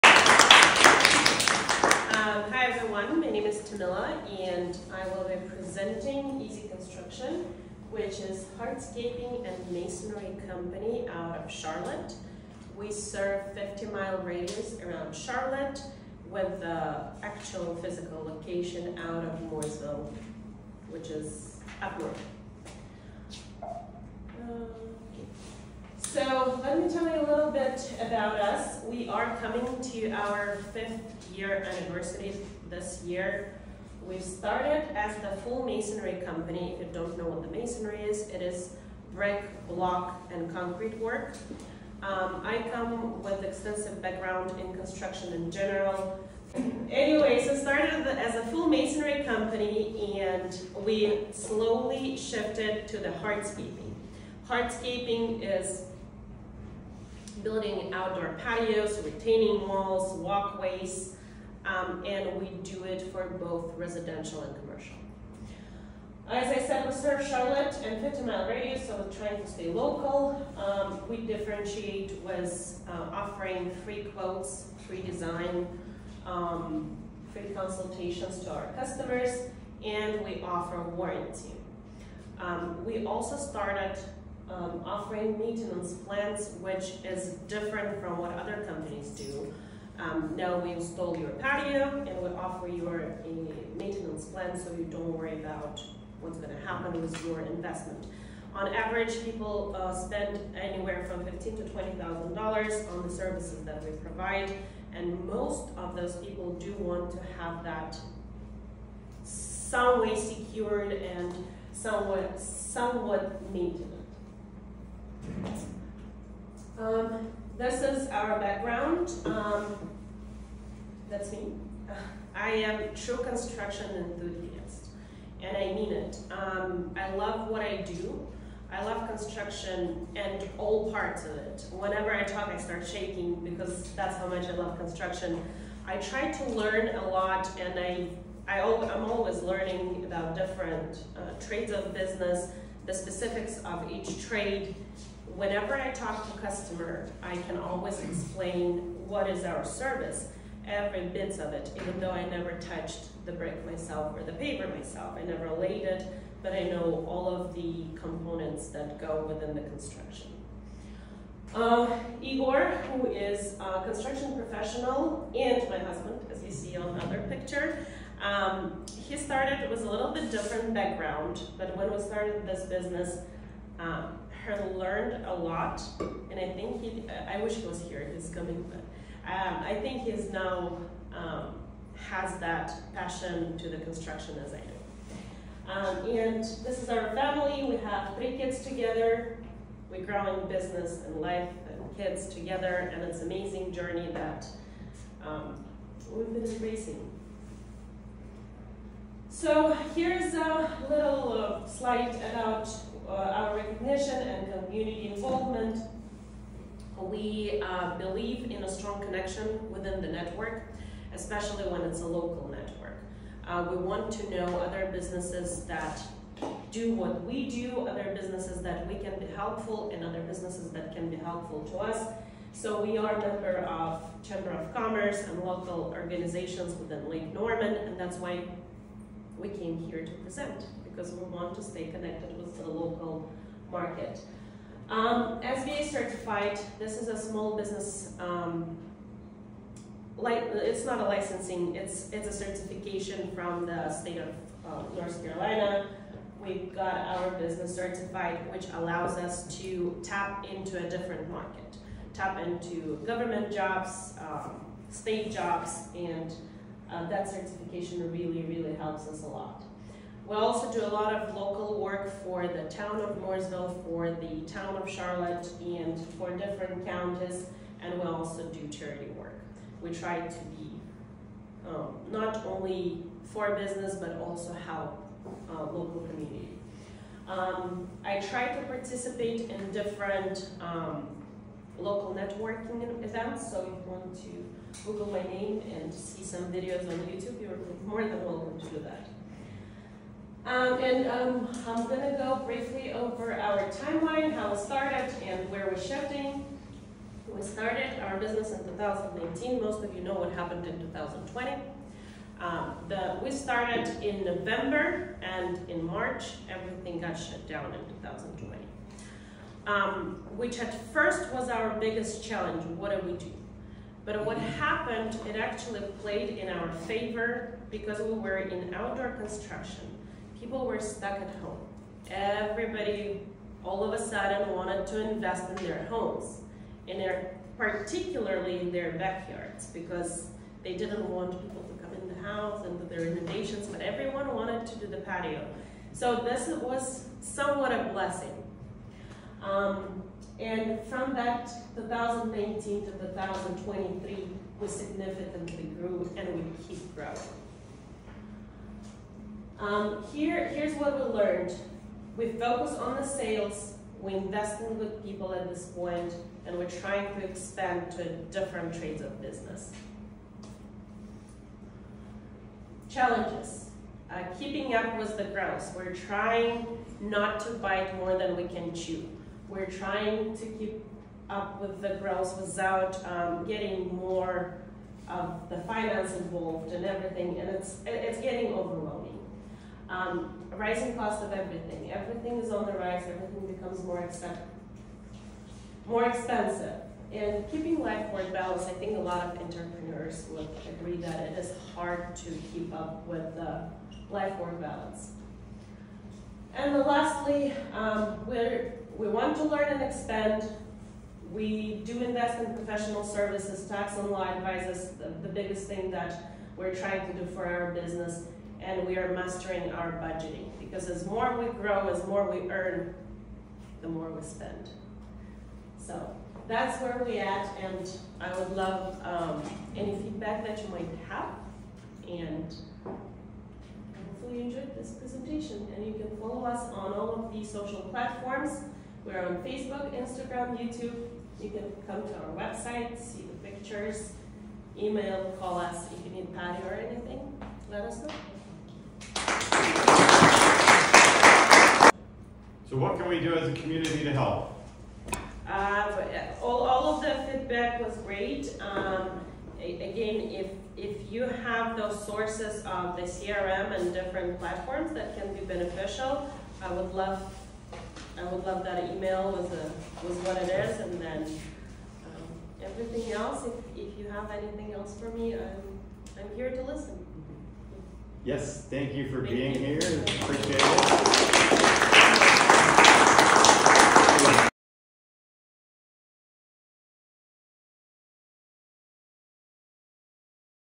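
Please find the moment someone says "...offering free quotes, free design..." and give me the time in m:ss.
1:13.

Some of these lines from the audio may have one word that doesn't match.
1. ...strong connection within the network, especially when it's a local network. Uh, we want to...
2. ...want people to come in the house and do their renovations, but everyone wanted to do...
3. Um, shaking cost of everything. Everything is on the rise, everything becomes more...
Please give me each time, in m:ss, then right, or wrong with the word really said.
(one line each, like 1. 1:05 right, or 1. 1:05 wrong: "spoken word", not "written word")
1. 3:28 right
2. 5:31 right
3. 6:19 wrong: "rising", not "shaking".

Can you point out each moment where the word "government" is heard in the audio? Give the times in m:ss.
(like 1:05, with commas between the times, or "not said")
4:13.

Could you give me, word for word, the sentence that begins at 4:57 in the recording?
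We started our business in 2019.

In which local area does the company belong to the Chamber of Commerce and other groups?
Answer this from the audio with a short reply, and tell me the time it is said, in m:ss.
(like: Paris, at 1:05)
Lake Norman, at 3:47.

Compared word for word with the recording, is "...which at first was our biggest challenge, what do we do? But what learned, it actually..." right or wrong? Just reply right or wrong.
wrong.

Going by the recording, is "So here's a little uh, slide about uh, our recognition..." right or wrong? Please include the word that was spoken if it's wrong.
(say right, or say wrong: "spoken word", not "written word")
right.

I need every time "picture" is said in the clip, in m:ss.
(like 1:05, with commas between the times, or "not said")
2:47, 7:13.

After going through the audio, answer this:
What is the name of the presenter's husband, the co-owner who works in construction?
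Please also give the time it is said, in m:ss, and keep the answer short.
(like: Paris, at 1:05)
Igor, at 2:42.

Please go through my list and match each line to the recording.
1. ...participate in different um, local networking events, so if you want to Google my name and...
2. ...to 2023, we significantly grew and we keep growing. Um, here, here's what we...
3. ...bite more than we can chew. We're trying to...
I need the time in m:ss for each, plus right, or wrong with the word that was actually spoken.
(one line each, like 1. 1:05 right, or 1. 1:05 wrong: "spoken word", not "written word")
1. 4:38 right
2. 5:42 right
3. 6:07 right.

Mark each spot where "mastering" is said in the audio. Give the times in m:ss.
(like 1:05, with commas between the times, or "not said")
6:49.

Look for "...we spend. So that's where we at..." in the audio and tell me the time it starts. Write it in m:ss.
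6:54.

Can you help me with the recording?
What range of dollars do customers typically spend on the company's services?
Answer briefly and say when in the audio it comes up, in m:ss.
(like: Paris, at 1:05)
$15,000 to $20,000, at 1:41.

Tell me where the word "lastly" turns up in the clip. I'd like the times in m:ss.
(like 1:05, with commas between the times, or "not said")
6:36.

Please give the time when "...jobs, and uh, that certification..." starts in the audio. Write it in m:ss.
4:15.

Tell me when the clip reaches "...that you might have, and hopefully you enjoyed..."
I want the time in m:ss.
7:00.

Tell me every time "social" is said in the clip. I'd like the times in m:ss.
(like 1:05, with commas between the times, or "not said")
7:07.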